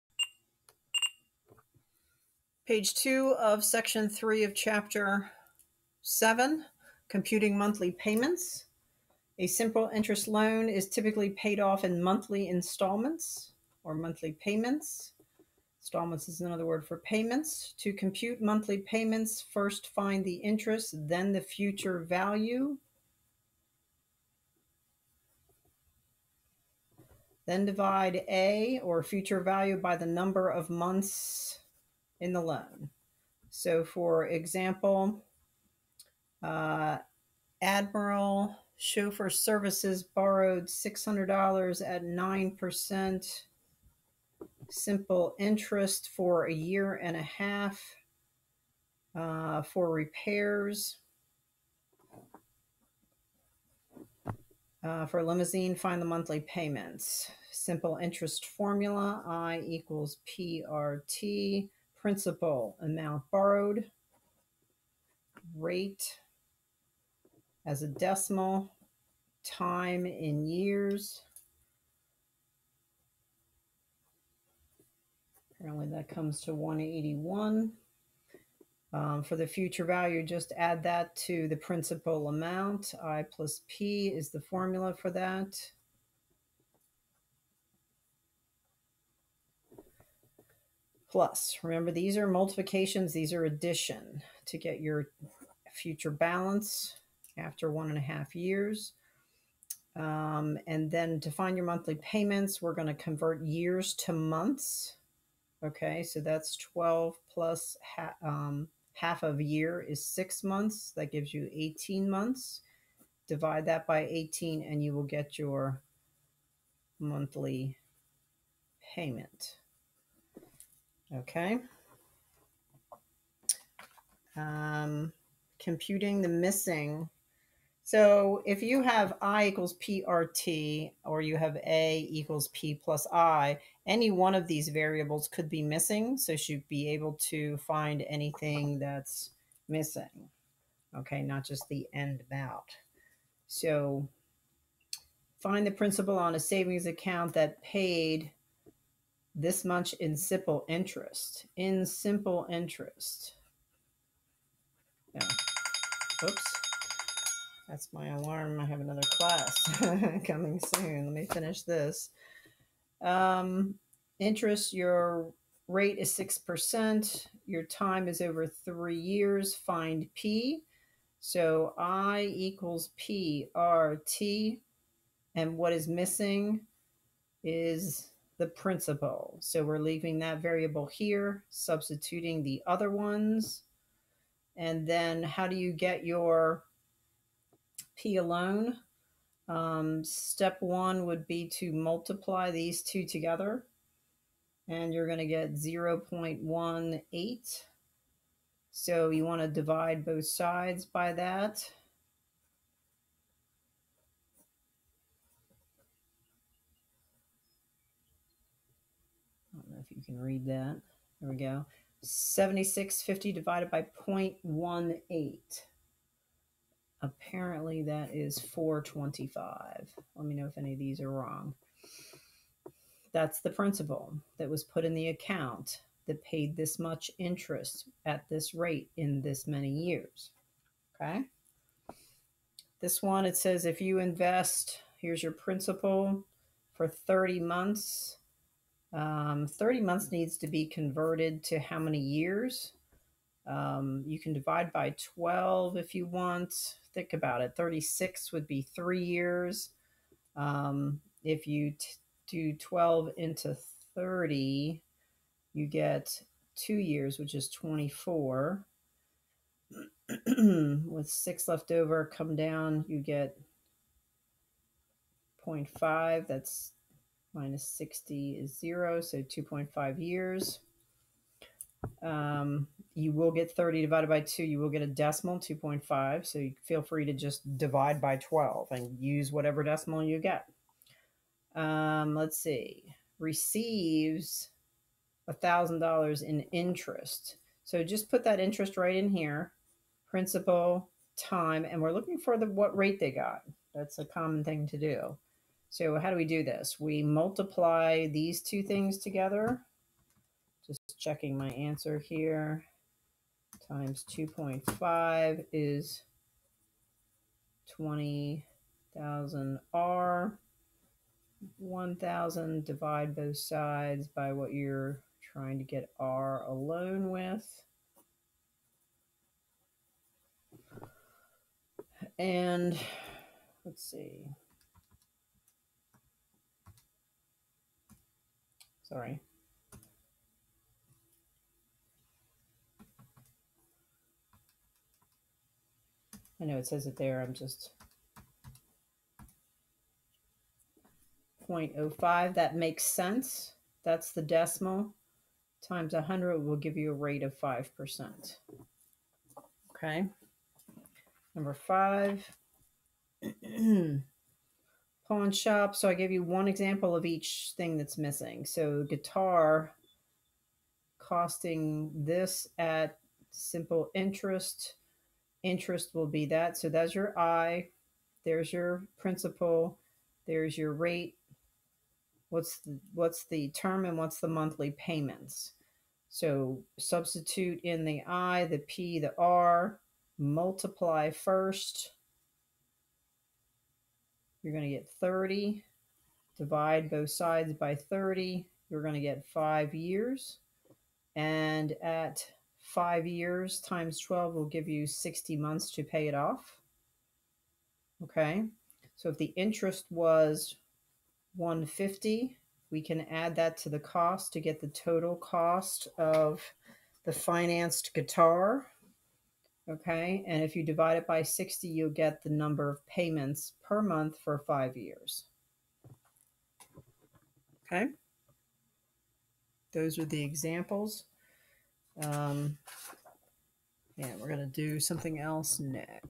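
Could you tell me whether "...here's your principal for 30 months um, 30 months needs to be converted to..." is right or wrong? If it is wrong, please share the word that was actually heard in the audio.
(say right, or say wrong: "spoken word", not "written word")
right.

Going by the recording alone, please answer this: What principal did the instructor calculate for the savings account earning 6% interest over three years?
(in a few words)
425.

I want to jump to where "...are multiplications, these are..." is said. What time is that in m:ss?
1:32.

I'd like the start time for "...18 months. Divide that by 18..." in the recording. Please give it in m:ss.
1:51.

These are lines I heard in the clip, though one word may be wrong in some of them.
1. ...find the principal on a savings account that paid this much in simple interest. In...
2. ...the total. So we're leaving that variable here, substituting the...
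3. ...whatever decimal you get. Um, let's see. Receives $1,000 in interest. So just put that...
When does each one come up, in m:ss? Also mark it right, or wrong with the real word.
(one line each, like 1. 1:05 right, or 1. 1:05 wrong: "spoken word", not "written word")
1. 2:25 right
2. 2:58 wrong: "principal", not "total"
3. 4:39 right.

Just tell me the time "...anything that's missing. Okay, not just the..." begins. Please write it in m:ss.
2:18.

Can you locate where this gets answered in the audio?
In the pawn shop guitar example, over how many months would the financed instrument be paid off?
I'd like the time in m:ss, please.
6:34.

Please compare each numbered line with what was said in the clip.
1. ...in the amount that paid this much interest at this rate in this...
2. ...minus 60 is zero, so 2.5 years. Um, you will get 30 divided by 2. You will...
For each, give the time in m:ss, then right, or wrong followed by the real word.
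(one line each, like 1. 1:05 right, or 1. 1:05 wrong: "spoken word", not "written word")
1. 3:44 wrong: "account", not "amount"
2. 4:27 right.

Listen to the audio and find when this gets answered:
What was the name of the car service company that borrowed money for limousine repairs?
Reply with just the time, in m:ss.
0:37.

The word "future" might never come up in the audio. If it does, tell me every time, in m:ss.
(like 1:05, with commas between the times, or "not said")
0:21, 0:29, 1:19, 1:35.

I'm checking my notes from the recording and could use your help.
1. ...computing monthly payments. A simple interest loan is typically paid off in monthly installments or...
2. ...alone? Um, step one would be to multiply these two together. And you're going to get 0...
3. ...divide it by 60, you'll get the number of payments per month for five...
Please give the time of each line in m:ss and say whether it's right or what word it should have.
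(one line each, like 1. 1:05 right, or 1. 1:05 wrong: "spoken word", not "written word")
1. 0:07 right
2. 3:08 right
3. 6:50 right.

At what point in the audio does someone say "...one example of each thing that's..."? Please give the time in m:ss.
5:56.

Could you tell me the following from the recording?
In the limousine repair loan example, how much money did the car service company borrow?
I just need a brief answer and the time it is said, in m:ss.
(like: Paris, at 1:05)
$600, at 0:40.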